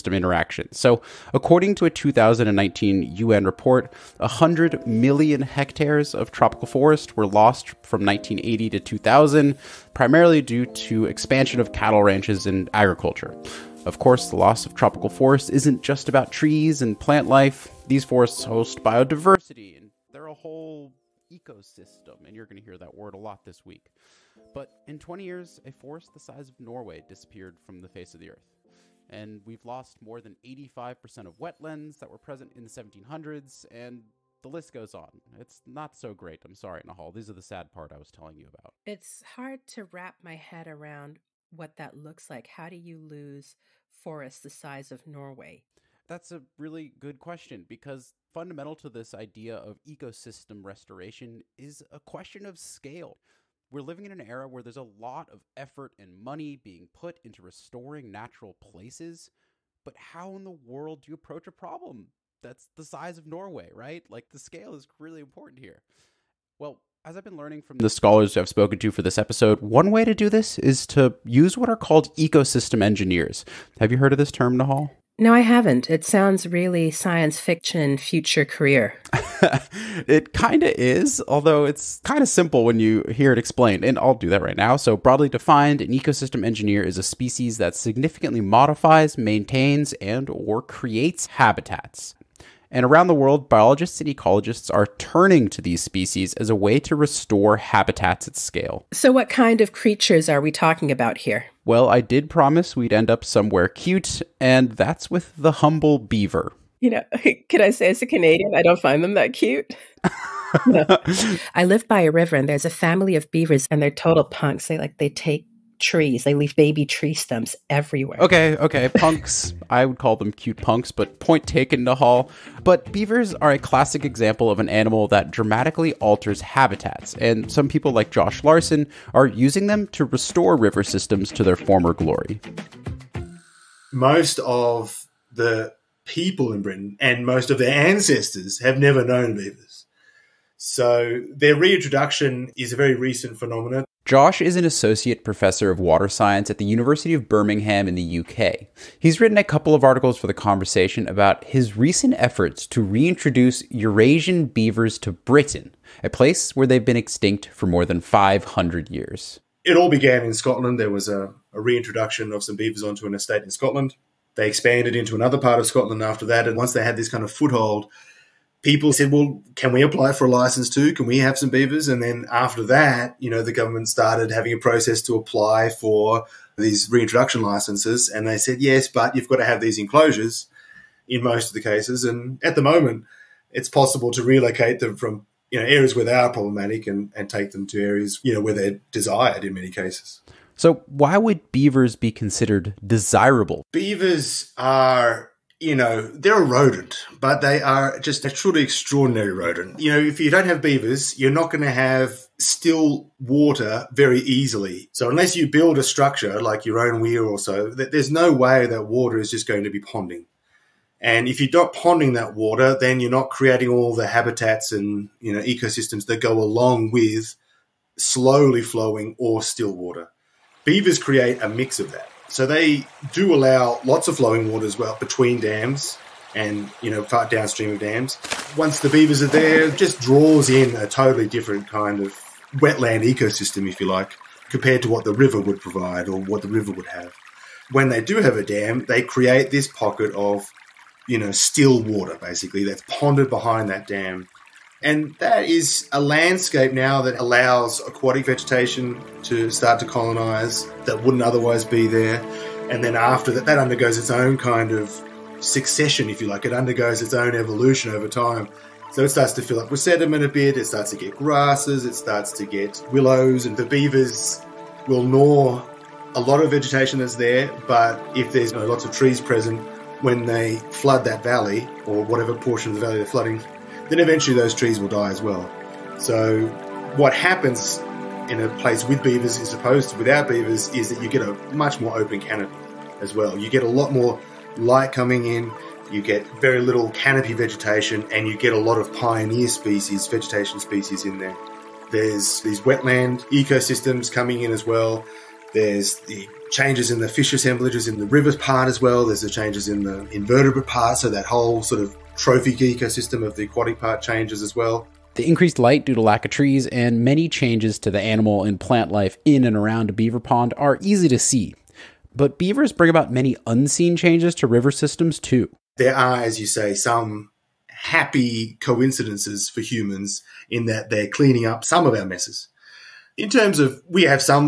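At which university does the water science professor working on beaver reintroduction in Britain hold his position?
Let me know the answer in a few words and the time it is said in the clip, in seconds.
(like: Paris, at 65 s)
University of Birmingham, at 146 s.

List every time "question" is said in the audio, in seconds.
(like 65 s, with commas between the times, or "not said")
47 s, 51 s.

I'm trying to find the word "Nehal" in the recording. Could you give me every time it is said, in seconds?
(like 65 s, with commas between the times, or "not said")
36 s, 74 s.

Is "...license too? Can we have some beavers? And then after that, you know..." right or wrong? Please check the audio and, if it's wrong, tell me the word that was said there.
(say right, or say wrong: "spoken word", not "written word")
right.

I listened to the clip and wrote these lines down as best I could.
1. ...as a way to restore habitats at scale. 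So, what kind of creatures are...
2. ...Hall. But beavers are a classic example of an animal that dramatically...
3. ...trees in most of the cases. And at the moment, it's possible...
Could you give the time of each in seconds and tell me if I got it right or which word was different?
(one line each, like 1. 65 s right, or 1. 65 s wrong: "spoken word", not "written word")
1. 96 s right
2. 121 s right
3. 179 s wrong: "enclosures", not "trees".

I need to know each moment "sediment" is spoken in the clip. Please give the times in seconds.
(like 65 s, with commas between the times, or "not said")
259 s.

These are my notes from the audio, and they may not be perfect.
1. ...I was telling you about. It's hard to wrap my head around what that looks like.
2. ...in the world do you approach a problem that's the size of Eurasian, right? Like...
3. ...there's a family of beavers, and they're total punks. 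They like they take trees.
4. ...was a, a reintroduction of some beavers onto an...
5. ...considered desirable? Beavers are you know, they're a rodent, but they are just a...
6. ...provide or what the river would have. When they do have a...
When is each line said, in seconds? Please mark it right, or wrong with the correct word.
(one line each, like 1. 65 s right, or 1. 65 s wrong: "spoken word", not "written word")
1. 37 s right
2. 60 s wrong: "Norway", not "Eurasian"
3. 112 s right
4. 160 s right
5. 192 s right
6. 235 s right.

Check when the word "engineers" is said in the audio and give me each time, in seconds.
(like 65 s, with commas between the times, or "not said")
72 s, 86 s.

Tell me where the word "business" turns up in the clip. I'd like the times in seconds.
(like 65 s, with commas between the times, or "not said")
not said.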